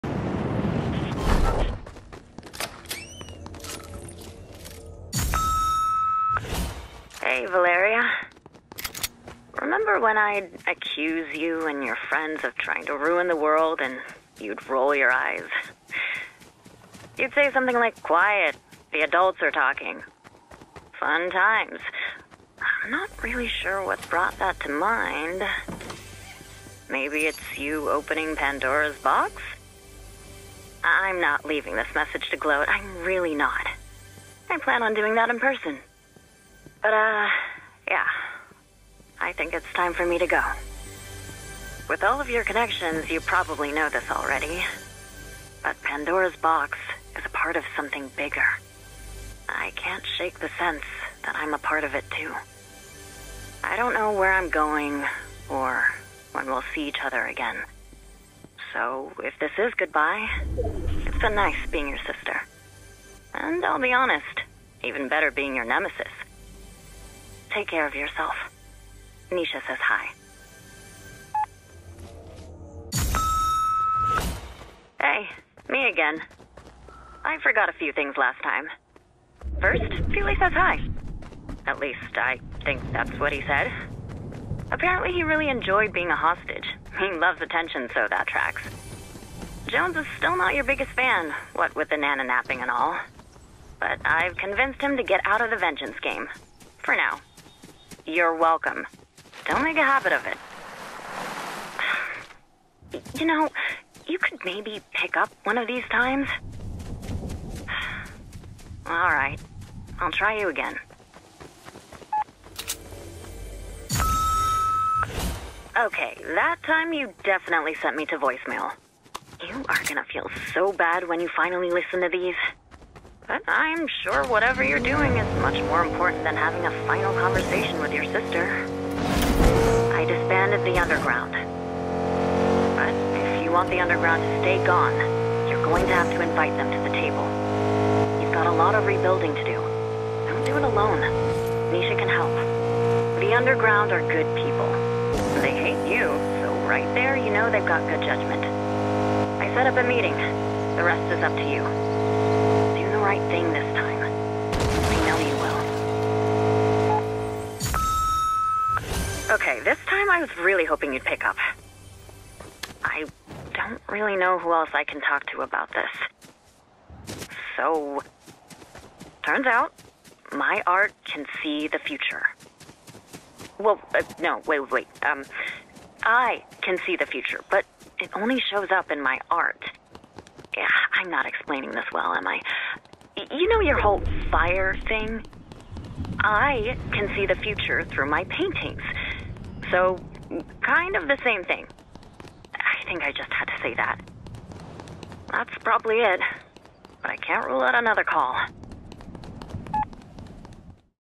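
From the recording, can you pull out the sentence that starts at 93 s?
But I've convinced him to get out of the vengeance game.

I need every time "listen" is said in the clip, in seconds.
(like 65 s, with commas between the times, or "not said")
121 s.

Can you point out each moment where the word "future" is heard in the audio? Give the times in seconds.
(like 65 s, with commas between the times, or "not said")
171 s, 177 s, 187 s.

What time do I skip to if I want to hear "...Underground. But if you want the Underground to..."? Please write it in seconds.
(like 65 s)
130 s.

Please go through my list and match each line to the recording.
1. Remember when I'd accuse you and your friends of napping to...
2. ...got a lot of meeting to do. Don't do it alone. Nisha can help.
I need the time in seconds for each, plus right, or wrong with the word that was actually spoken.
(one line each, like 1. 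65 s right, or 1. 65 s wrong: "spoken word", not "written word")
1. 9 s wrong: "trying", not "napping"
2. 138 s wrong: "rebuilding", not "meeting".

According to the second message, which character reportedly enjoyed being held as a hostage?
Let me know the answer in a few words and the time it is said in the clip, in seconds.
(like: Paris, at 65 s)
Peely, at 79 s.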